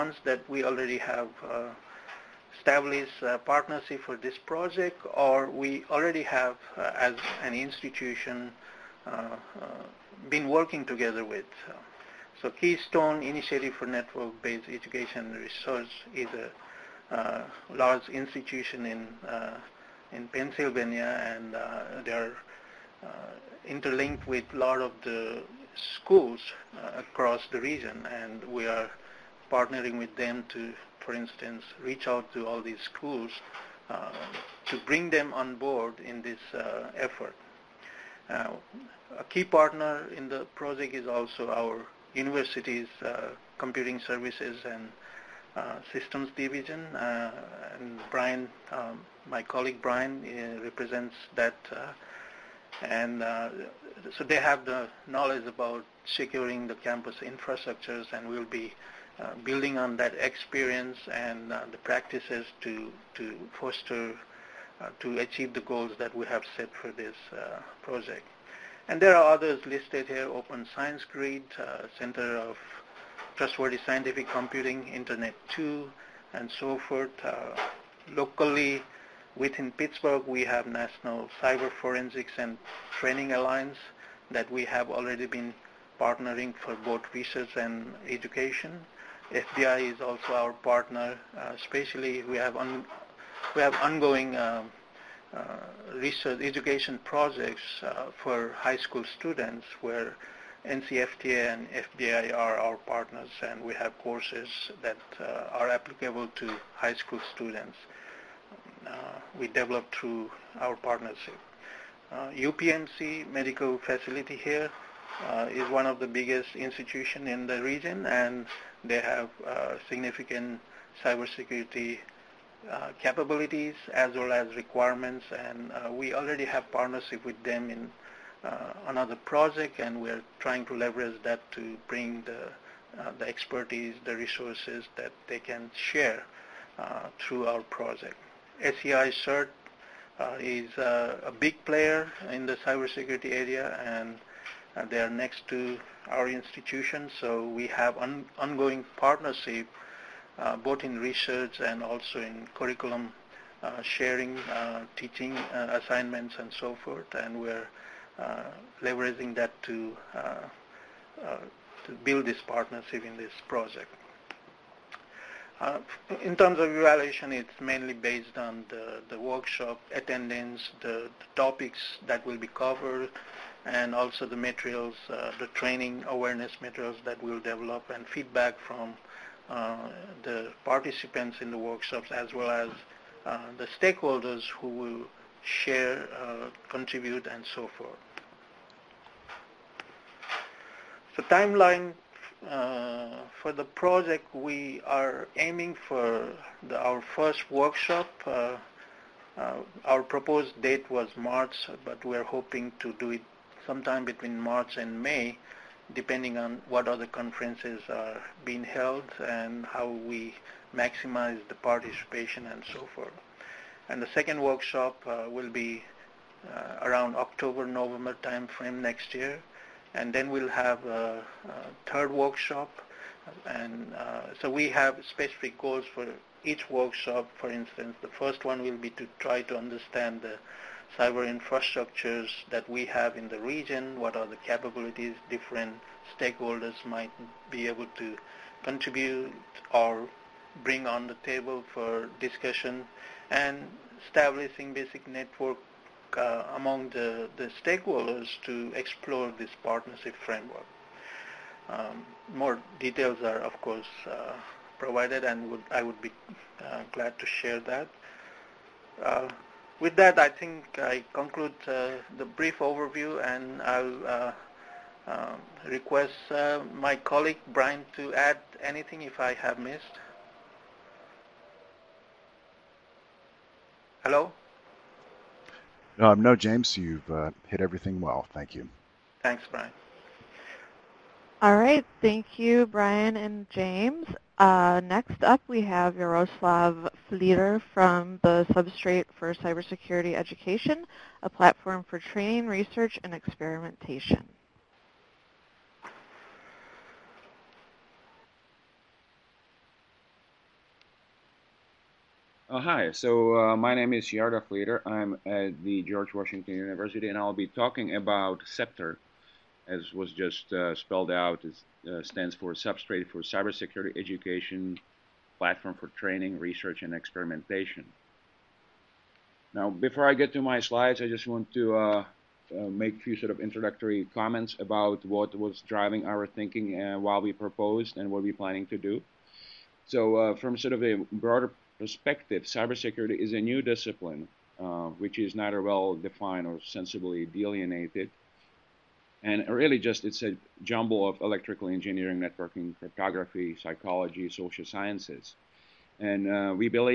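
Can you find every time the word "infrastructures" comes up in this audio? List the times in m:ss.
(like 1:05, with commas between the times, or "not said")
0:57, 3:51.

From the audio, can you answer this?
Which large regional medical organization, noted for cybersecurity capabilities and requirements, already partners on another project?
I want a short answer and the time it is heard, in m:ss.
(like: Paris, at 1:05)
UPMC, at 1:52.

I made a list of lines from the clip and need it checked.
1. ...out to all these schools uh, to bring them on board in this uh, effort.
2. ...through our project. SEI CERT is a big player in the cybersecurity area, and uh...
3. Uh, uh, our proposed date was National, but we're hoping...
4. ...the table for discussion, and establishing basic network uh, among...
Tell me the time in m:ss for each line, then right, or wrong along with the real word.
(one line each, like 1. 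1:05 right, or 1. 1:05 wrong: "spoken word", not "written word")
1. 0:32 right
2. 2:17 right
3. 3:18 wrong: "March", not "National"
4. 4:01 right.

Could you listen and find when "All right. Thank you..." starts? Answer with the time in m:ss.
4:41.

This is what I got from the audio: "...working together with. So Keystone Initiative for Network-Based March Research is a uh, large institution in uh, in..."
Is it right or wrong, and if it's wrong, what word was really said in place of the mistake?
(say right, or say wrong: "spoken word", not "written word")
wrong: "Education", not "March".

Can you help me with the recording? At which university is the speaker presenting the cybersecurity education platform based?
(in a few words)
George Washington University.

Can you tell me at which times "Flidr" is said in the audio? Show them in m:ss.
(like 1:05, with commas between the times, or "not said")
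4:47, 5:04.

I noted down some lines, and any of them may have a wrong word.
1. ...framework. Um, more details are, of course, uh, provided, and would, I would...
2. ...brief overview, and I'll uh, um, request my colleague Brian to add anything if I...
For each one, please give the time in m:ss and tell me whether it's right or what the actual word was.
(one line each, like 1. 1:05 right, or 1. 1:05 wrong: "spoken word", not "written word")
1. 4:10 right
2. 4:22 right.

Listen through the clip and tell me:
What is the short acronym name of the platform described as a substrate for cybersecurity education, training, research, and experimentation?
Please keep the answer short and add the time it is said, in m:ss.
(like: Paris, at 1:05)
SCEPTRE, at 5:08.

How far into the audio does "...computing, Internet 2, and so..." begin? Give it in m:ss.
1:14.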